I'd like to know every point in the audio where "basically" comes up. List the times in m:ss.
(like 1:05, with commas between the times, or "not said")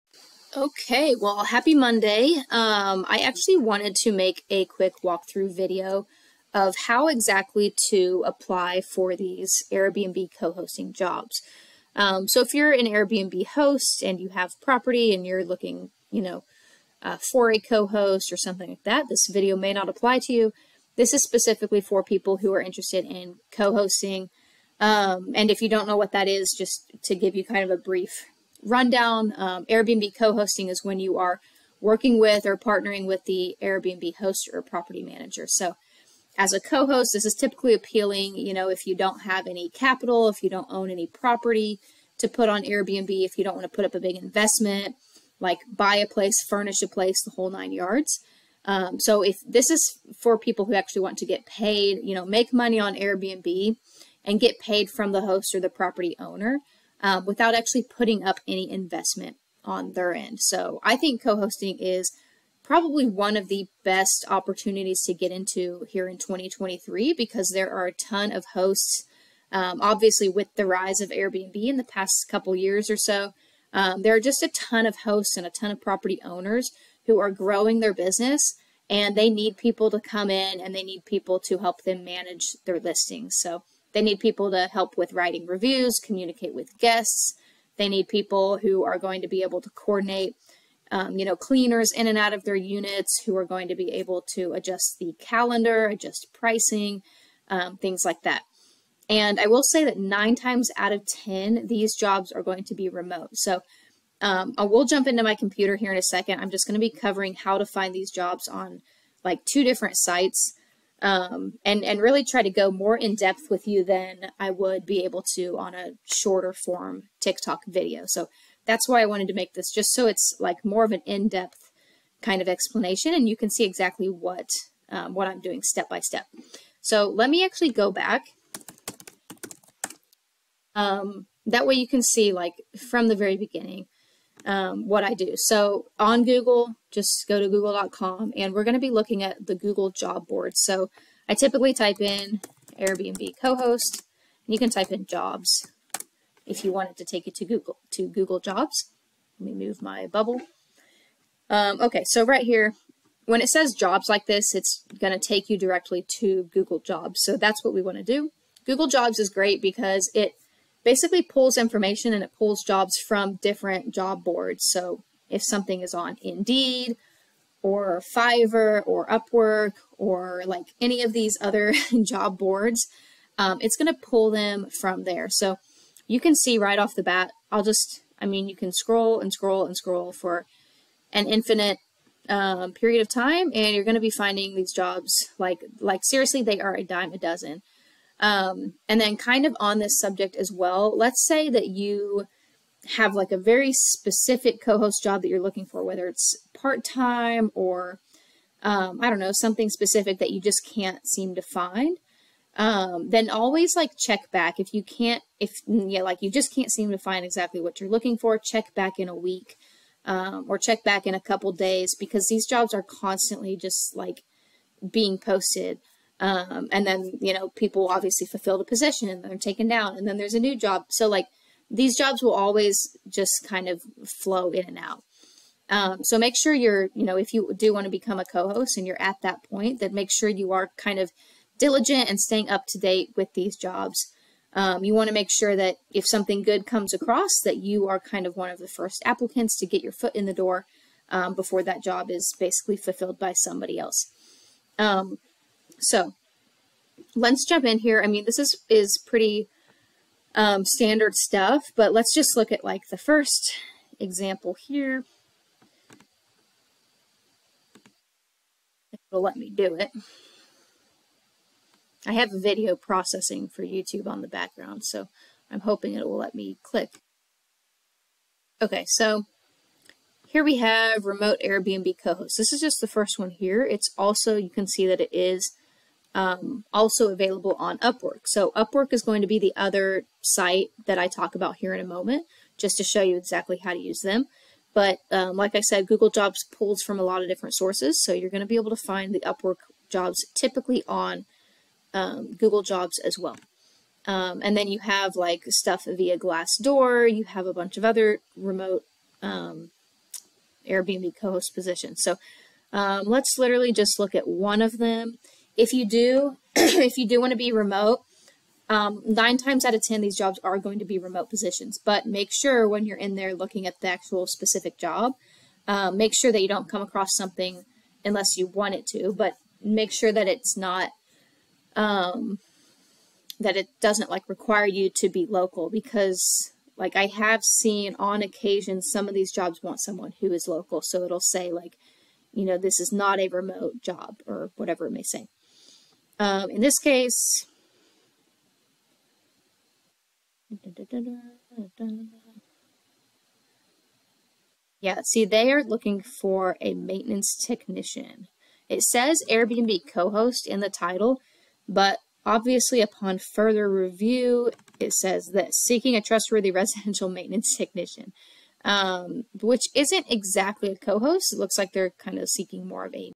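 2:40, 4:02.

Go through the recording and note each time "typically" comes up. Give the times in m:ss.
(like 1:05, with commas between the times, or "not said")
0:37, 2:21, 4:50.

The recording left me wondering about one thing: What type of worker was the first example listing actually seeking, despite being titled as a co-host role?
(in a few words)
residential maintenance technician.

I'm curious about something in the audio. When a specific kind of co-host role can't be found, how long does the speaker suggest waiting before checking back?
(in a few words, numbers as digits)
a week.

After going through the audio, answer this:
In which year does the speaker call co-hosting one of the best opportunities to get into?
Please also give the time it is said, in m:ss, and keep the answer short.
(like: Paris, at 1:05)
2023, at 1:06.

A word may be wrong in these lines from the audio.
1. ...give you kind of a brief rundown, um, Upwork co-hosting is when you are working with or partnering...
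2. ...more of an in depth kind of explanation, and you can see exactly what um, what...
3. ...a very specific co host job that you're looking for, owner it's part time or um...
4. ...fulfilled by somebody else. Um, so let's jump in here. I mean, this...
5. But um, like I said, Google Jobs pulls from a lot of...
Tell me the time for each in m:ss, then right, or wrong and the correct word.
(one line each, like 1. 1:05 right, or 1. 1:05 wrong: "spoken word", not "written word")
1. 0:27 wrong: "Airbnb", not "Upwork"
2. 2:00 right
3. 3:13 wrong: "whether", not "owner"
4. 4:02 right
5. 4:44 right.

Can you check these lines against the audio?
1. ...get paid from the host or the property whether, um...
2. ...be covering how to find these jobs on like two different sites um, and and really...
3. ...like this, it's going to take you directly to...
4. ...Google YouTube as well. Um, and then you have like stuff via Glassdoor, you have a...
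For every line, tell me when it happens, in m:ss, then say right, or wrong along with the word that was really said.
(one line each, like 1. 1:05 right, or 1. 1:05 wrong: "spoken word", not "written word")
1. 0:54 wrong: "owner", not "whether"
2. 1:46 right
3. 2:34 right
4. 4:52 wrong: "Jobs", not "YouTube".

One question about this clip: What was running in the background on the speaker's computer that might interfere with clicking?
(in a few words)
video processing for YouTube.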